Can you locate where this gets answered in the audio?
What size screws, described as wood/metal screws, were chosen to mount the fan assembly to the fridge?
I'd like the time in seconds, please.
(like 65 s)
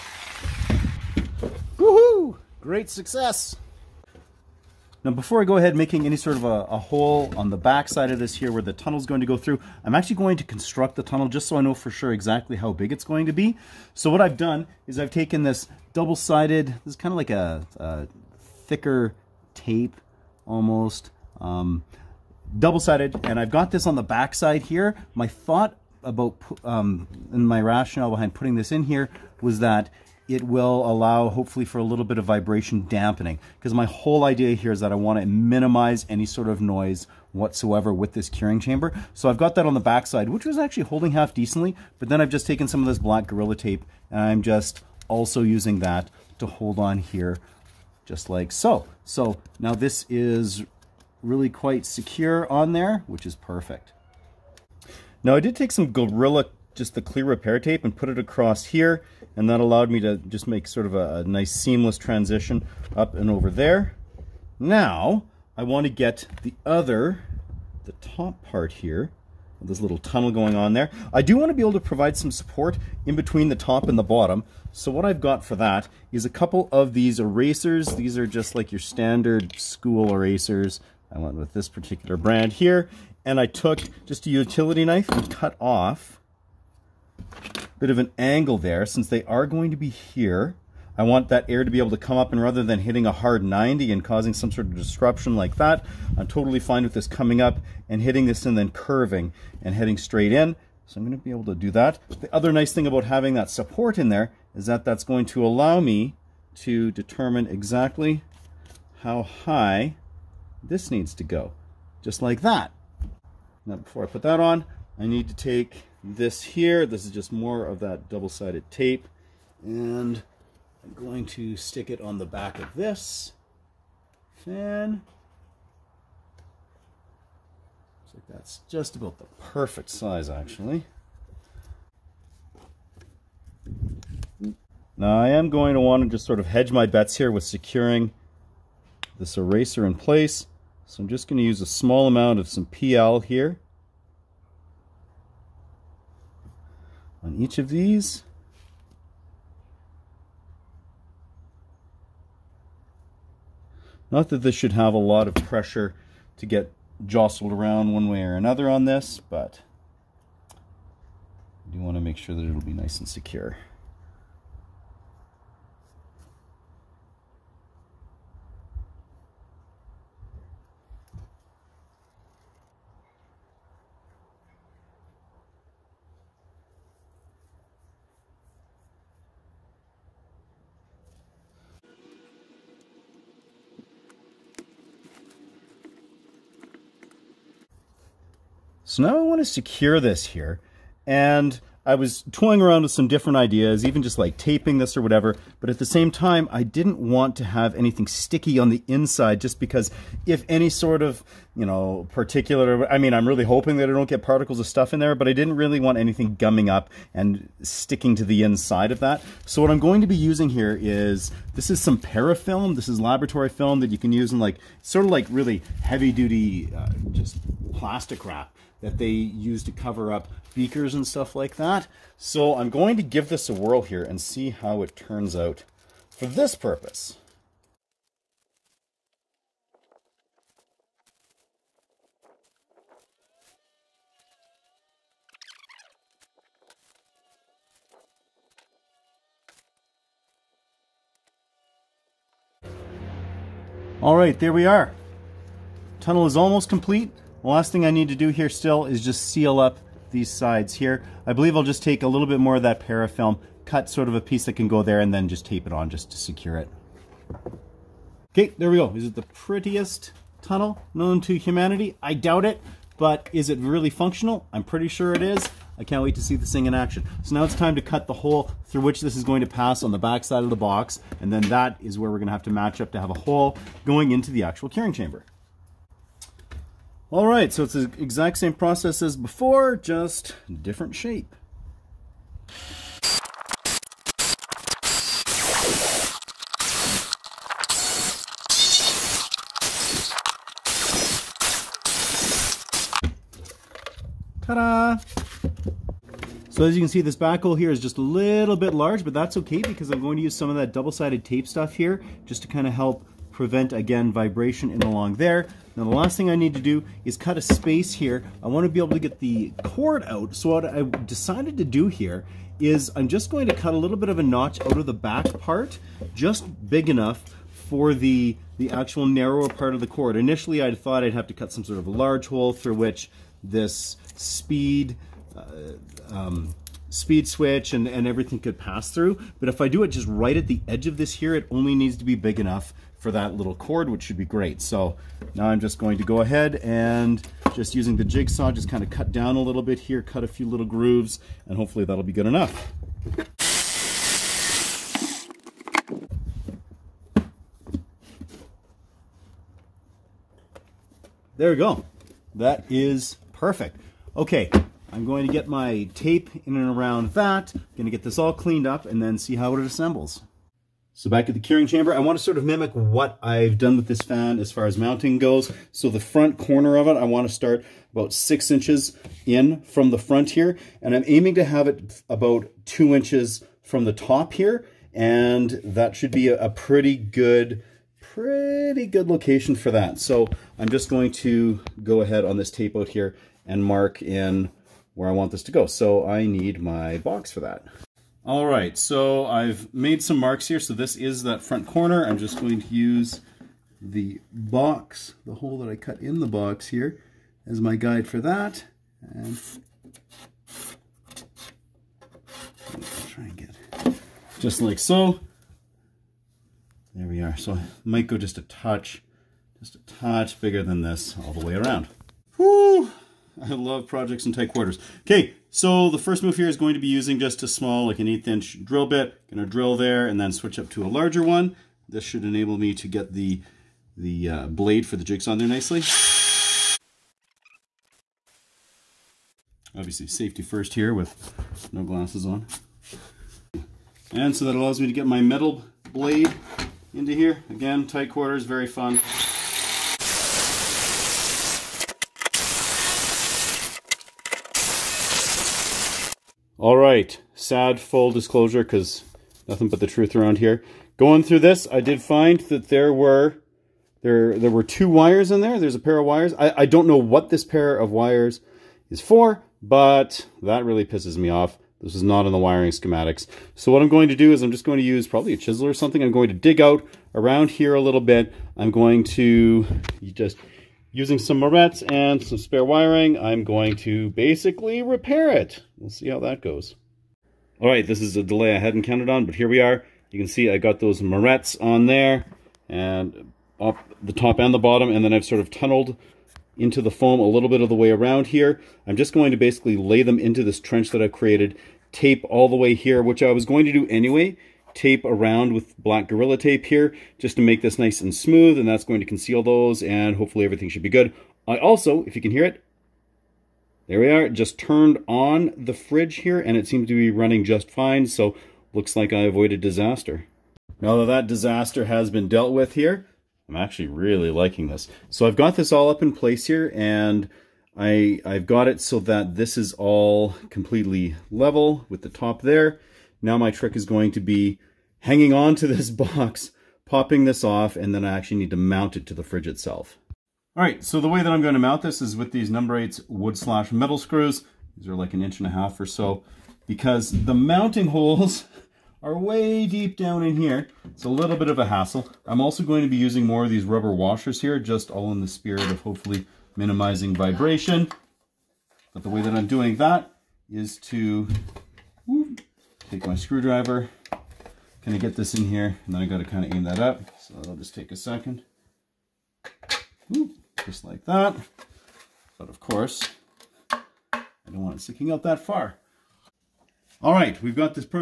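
532 s.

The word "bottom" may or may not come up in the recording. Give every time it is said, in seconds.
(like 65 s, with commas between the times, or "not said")
74 s, 484 s.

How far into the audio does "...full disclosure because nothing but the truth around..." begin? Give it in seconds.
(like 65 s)
447 s.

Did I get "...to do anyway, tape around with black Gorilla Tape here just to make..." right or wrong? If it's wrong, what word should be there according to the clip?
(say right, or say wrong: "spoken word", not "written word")
right.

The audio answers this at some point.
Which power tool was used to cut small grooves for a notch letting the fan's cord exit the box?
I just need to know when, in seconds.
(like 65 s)
338 s.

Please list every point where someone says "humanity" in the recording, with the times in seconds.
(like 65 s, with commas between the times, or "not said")
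261 s.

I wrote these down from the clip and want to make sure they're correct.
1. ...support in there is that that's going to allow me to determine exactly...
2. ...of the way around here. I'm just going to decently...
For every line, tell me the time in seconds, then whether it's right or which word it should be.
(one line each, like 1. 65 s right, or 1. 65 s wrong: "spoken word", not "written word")
1. 103 s right
2. 487 s wrong: "basically", not "decently".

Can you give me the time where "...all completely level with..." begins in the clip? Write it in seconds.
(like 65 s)
519 s.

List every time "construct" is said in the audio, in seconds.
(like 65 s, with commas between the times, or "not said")
10 s.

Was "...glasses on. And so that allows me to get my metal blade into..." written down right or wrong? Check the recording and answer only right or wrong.
right.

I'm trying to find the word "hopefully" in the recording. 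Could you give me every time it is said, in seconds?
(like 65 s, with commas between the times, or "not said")
31 s, 341 s, 500 s, 545 s.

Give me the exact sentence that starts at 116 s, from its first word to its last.
This is just more of that double-sided tape.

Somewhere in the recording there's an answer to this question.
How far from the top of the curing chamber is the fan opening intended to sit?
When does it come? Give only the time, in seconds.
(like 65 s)
372 s.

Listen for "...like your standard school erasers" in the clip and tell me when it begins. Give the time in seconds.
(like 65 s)
78 s.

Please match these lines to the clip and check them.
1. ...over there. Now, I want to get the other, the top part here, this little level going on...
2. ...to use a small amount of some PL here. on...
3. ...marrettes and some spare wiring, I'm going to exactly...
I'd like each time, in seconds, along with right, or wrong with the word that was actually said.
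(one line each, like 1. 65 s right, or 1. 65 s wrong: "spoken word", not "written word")
1. 63 s wrong: "tunnel", not "level"
2. 141 s right
3. 471 s wrong: "basically", not "exactly".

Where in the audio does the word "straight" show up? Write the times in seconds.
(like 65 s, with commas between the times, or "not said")
99 s.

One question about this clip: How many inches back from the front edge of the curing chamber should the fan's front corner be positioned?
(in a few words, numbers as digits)
6 inches.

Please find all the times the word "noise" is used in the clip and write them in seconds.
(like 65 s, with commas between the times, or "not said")
36 s.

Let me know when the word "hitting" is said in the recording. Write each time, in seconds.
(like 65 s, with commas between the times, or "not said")
92 s, 98 s.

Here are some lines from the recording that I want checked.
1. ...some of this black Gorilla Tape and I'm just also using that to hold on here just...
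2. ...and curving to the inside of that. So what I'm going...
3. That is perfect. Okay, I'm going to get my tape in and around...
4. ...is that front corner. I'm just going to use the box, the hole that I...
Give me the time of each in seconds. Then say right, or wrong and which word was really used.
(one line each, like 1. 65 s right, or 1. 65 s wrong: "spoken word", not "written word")
1. 42 s right
2. 207 s wrong: "sticking", not "curving"
3. 352 s right
4. 390 s right.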